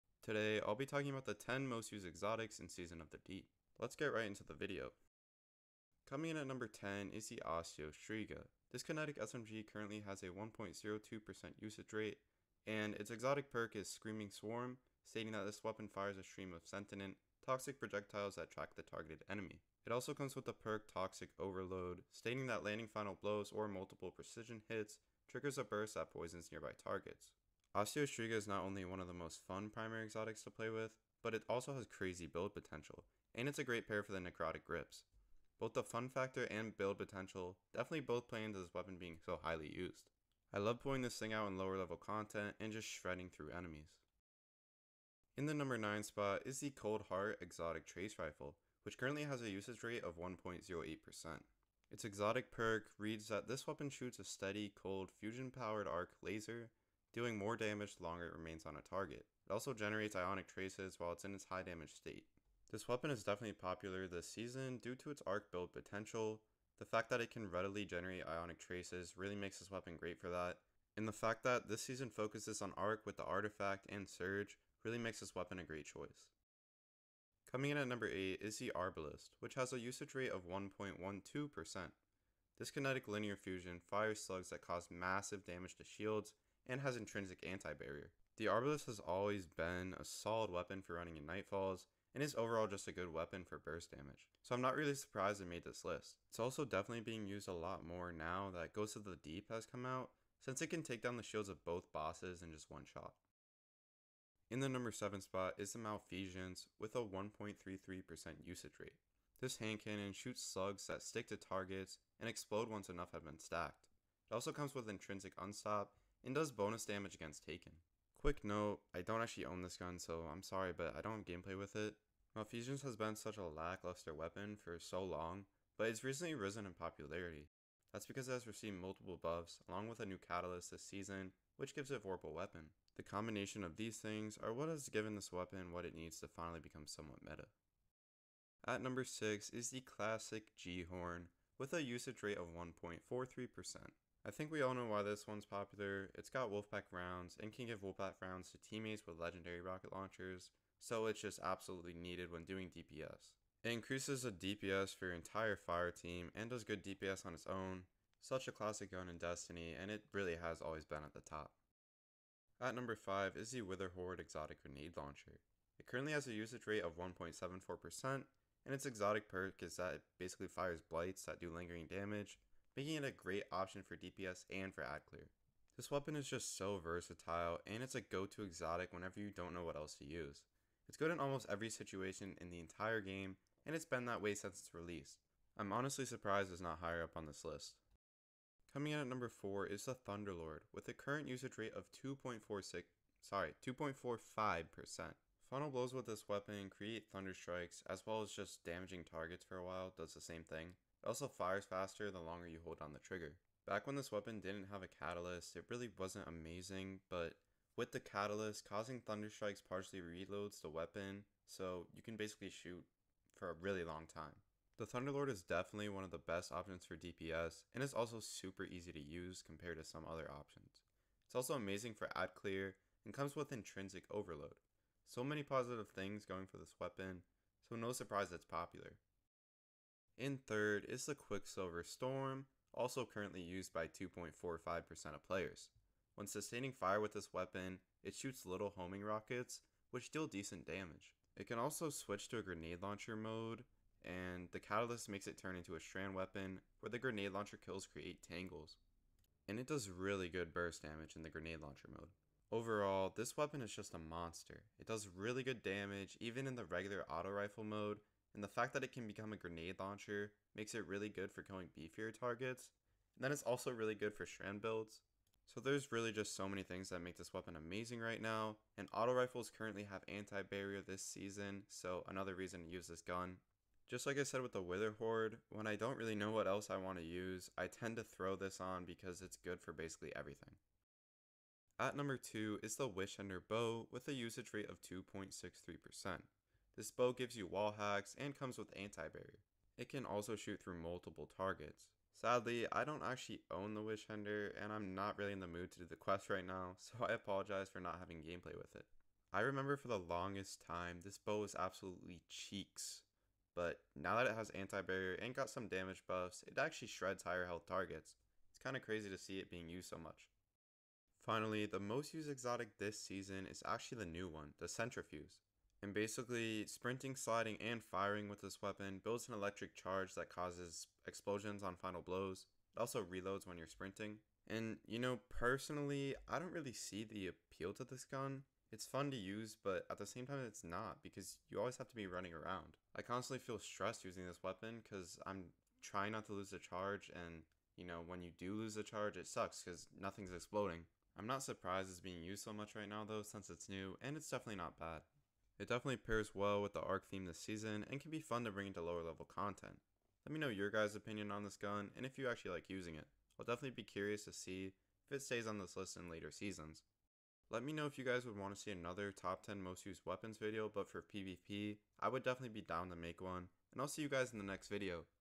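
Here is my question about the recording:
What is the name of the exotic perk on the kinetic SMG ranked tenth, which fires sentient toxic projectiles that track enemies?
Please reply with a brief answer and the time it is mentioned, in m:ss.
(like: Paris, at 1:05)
Screaming Swarm, at 0:13.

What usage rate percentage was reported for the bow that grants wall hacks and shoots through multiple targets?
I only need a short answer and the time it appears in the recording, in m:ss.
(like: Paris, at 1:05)
2.63%, at 4:44.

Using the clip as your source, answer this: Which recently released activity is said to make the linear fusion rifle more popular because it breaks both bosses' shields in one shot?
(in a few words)
Ghost of the Deep.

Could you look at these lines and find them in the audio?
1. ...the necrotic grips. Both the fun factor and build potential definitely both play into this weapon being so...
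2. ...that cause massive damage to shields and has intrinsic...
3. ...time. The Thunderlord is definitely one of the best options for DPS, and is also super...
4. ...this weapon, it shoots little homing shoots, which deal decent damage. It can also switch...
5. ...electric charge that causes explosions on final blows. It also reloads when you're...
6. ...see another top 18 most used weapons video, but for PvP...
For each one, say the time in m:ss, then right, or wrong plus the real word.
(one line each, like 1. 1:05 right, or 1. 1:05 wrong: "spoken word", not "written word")
1. 0:34 right
2. 1:24 right
3. 3:34 right
4. 3:57 wrong: "rockets", not "shoots"
5. 5:19 right
6. 5:58 wrong: "10", not "18".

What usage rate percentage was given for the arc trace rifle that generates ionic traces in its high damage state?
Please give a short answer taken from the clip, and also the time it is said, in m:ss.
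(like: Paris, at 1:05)
1.08%, at 0:50.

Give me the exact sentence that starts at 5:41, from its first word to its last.
I'm not surprised it's being used so much right now though, since it's new, and it's definitely not bad.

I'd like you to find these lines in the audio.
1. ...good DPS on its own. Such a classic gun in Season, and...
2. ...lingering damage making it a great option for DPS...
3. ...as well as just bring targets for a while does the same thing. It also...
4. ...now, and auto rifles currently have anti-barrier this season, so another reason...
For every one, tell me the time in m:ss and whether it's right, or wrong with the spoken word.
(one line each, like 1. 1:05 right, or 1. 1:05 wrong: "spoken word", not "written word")
1. 2:36 wrong: "Destiny", not "Season"
2. 2:51 right
3. 3:17 wrong: "damaging", not "bring"
4. 4:28 right.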